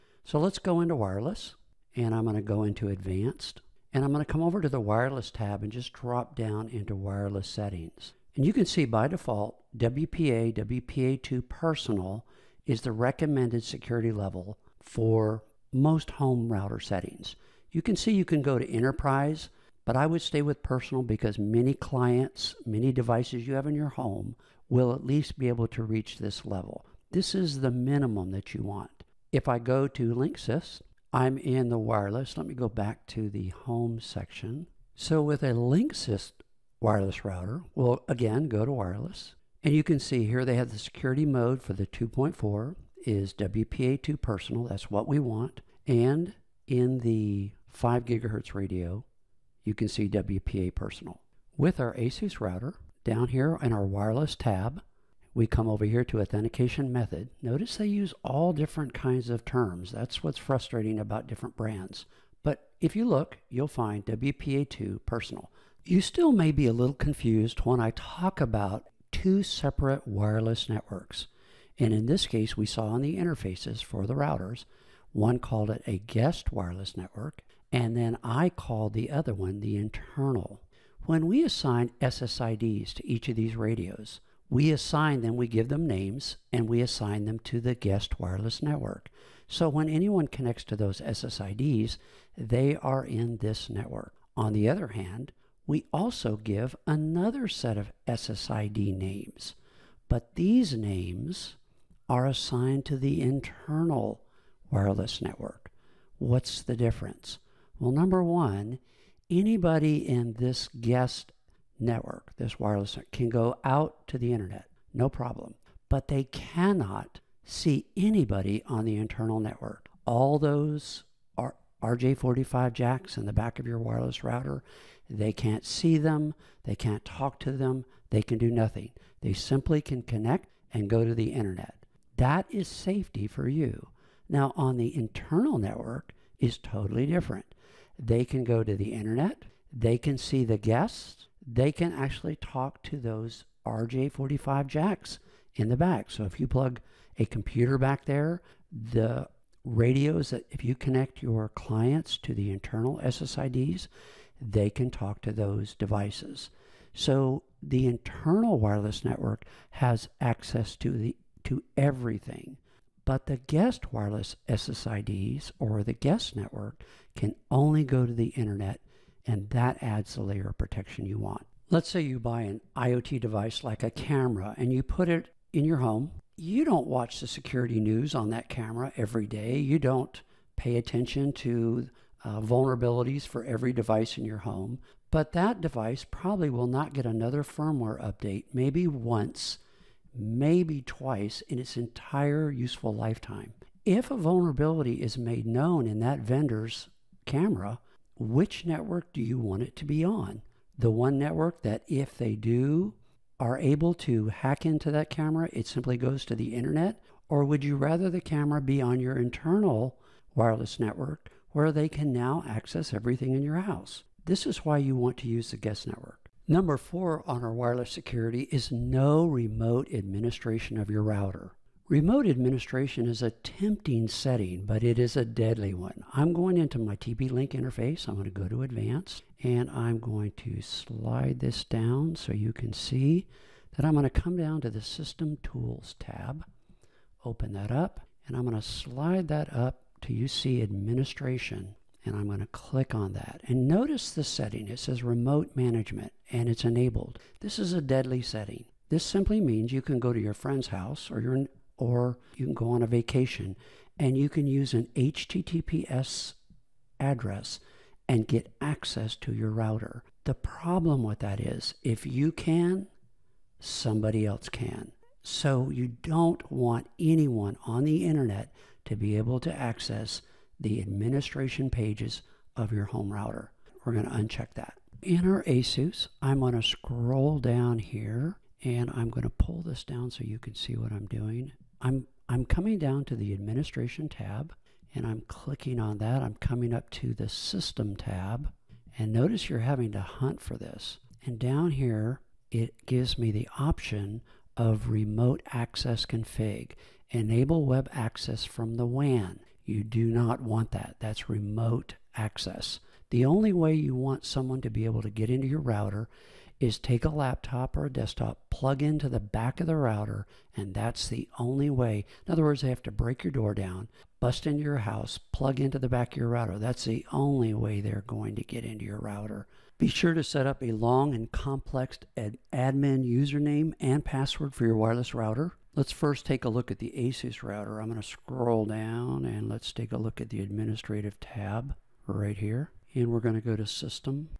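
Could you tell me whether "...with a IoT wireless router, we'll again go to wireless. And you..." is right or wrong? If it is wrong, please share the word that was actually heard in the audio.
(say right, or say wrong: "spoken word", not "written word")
wrong: "Linksys", not "IoT".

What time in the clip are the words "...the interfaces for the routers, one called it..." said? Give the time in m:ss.
1:13.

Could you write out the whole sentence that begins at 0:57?
Notice they use all different kinds of terms.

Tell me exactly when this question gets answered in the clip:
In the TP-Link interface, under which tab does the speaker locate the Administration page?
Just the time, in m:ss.
3:54.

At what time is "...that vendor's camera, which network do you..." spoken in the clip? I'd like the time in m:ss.
3:16.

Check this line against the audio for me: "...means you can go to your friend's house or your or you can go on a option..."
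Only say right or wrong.
wrong.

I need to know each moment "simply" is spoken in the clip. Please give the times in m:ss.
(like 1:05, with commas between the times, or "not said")
2:09, 3:25, 4:09.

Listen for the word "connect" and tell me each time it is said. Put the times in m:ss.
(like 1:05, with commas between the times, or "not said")
1:30, 2:10, 2:30.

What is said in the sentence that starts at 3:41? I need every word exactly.
Remote administration is a tempting setting, but it is a deadly one.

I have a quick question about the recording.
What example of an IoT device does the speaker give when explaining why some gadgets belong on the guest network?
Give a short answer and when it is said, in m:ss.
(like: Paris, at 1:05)
a camera, at 2:53.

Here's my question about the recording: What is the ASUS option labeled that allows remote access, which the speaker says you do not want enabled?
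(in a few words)
Enable web access from the WAN.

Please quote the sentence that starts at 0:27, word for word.
This is the minimum that you want.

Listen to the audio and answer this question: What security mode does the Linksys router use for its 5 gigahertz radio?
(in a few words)
WPA personal.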